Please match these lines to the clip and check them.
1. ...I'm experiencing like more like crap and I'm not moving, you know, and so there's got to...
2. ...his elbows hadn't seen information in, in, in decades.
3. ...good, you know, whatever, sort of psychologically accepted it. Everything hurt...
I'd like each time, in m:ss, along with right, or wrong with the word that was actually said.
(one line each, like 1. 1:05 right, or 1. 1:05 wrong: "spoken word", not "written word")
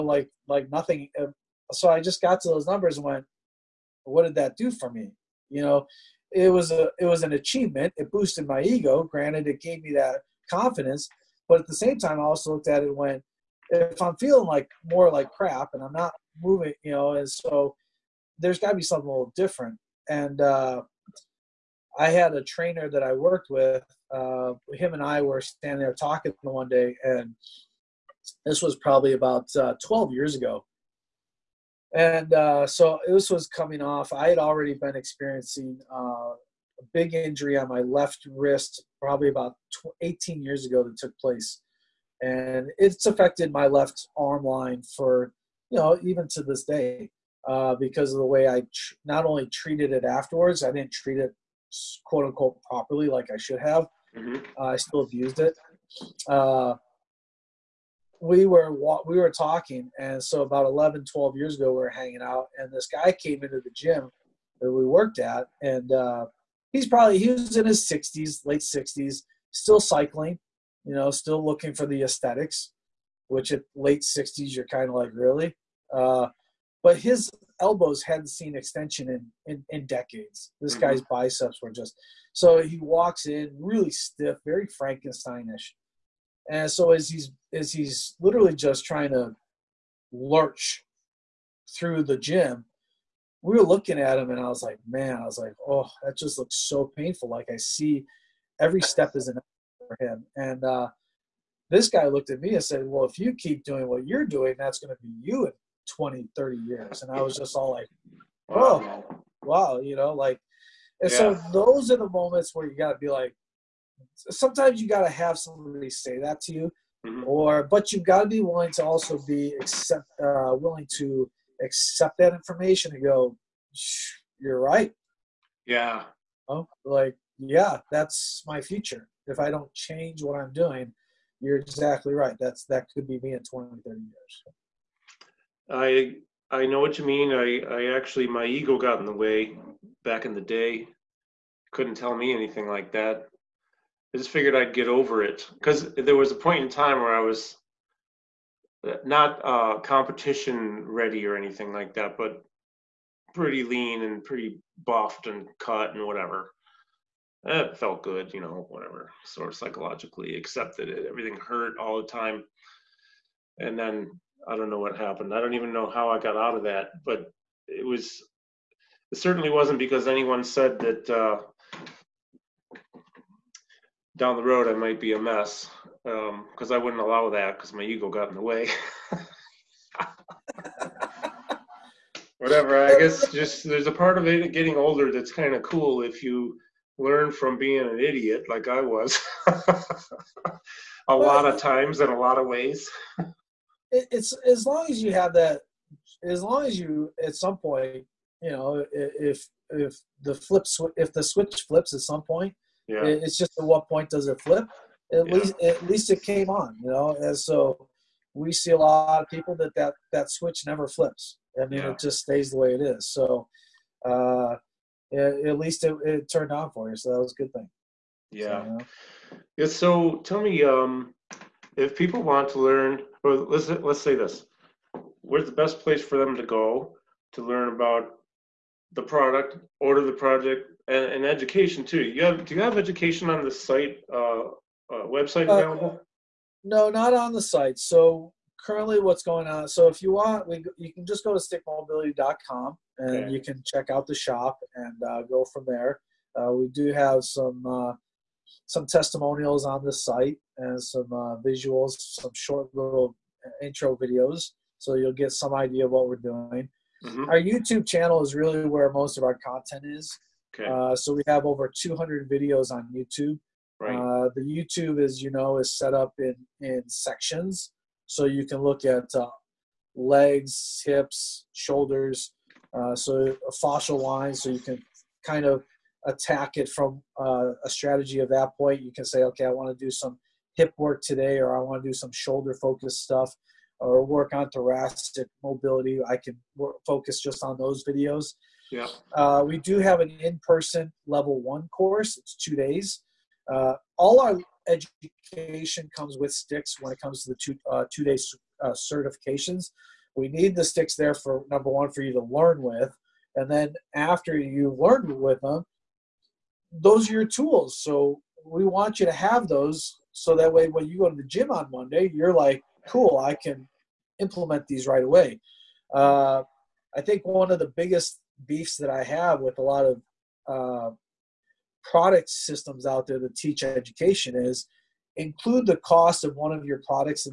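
1. 0:14 wrong: "feeling", not "experiencing"
2. 1:16 wrong: "extension", not "information"
3. 2:38 right.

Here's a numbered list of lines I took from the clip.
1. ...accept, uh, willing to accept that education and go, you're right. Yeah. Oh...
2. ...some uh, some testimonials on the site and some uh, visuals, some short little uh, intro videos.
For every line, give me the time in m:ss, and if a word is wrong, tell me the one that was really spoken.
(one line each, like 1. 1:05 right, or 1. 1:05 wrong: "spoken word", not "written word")
1. 1:59 wrong: "information", not "education"
2. 4:07 right.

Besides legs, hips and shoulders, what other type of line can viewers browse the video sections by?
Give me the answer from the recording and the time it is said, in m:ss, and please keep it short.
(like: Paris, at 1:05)
fascial line, at 4:33.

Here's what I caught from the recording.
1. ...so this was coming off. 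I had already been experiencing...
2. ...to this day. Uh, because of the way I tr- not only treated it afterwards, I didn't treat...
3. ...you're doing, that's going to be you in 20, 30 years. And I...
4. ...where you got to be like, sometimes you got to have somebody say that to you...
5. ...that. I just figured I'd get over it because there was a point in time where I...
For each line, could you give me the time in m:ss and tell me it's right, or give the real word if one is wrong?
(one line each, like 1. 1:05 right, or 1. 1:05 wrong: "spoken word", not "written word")
1. 0:32 right
2. 0:46 right
3. 1:44 right
4. 1:52 right
5. 2:22 right.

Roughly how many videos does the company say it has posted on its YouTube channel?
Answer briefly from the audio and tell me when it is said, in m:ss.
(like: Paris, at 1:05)
over 200, at 4:21.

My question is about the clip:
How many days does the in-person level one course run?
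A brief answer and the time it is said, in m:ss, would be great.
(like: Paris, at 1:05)
2, at 4:52.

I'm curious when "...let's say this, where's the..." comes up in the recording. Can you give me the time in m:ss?
3:43.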